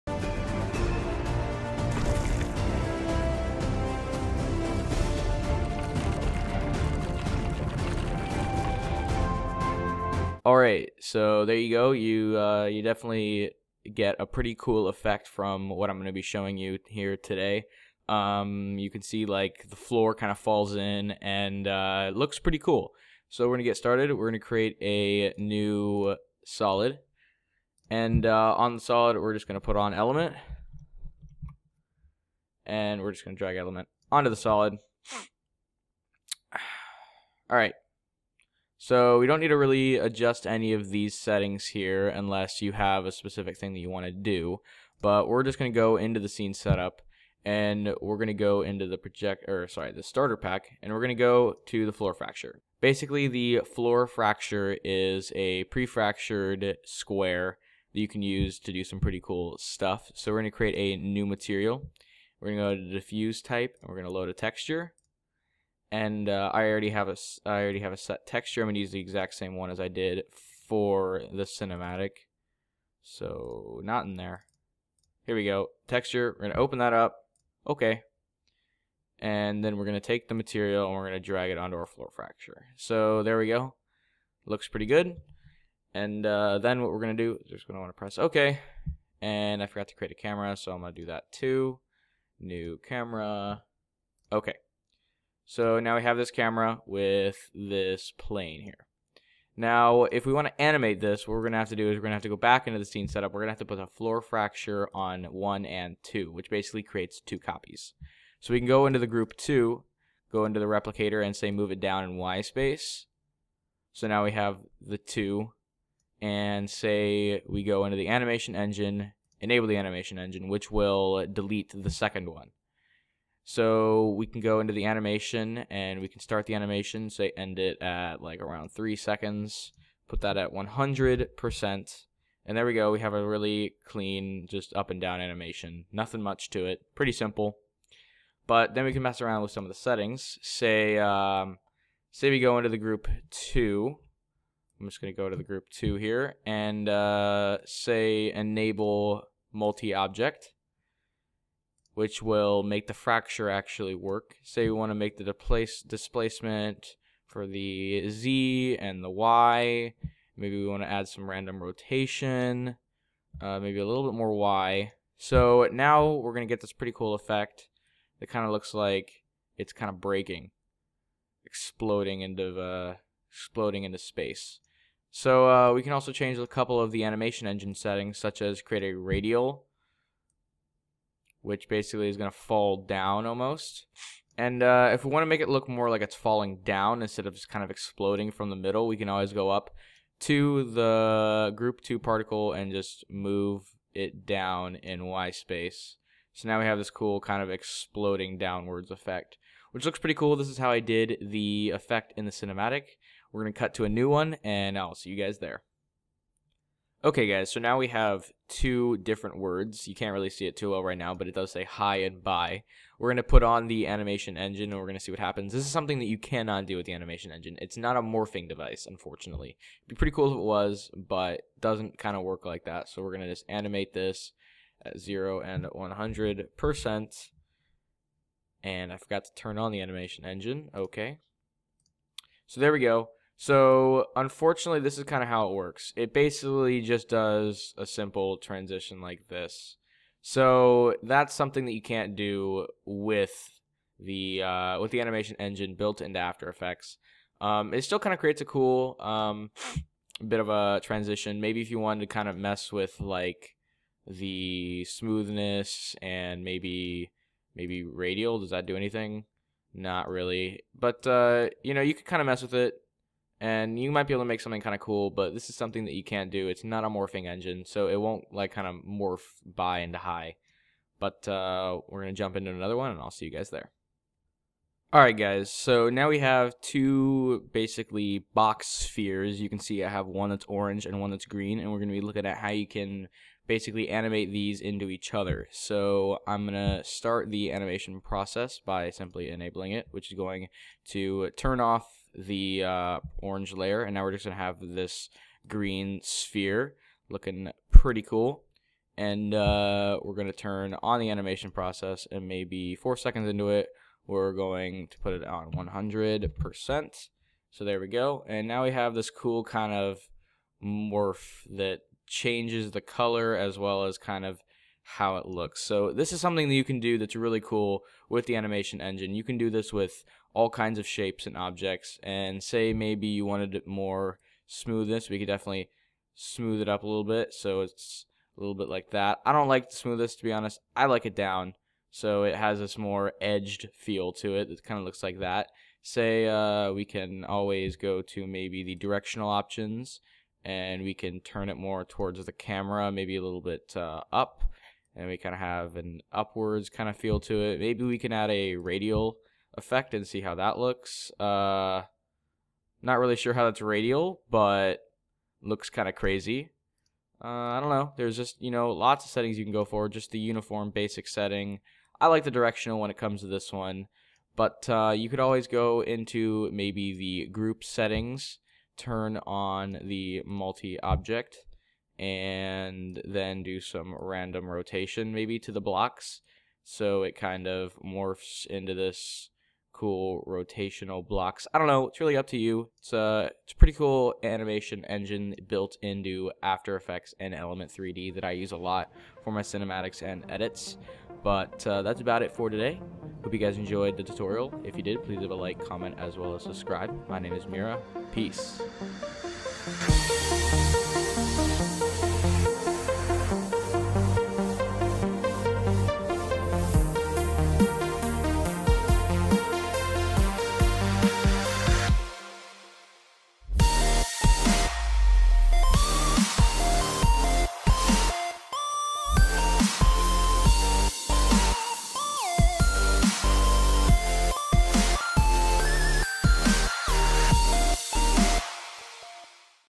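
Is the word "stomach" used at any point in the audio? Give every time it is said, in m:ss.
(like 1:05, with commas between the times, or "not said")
not said.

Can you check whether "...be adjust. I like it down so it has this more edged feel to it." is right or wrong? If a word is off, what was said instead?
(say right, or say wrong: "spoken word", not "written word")
wrong: "honest", not "adjust".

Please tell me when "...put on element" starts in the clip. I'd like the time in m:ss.
0:29.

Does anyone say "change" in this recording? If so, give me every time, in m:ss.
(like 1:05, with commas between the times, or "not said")
2:56, 5:12.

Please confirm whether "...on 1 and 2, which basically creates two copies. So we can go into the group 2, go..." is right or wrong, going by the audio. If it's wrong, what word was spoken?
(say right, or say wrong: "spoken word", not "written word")
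right.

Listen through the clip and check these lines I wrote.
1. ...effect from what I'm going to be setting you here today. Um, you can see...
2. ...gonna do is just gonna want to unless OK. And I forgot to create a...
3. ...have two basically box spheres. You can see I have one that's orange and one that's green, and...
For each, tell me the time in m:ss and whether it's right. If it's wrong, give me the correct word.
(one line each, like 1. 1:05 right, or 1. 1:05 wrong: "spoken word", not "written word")
1. 0:14 wrong: "showing", not "setting"
2. 1:27 wrong: "press", not "unless"
3. 4:36 right.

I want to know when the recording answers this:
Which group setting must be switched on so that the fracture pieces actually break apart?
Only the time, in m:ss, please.
2:29.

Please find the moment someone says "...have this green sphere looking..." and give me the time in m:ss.
4:54.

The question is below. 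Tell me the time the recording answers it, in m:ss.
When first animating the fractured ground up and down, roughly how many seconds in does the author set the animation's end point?
2:08.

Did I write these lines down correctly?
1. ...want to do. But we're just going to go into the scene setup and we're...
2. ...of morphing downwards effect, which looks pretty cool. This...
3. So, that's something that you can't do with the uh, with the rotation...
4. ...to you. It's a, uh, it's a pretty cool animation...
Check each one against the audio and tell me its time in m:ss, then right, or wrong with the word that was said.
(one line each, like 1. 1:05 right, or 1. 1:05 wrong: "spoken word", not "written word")
1. 0:43 right
2. 3:17 wrong: "exploding", not "morphing"
3. 4:00 wrong: "animation", not "rotation"
4. 6:22 right.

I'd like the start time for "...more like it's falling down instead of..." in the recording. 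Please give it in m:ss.
3:05.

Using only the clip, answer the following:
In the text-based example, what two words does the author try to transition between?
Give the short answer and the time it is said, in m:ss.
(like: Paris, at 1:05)
Hi and bye, at 3:31.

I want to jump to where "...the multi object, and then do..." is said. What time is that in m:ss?
6:09.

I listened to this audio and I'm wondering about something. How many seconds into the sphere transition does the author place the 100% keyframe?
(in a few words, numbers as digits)
4.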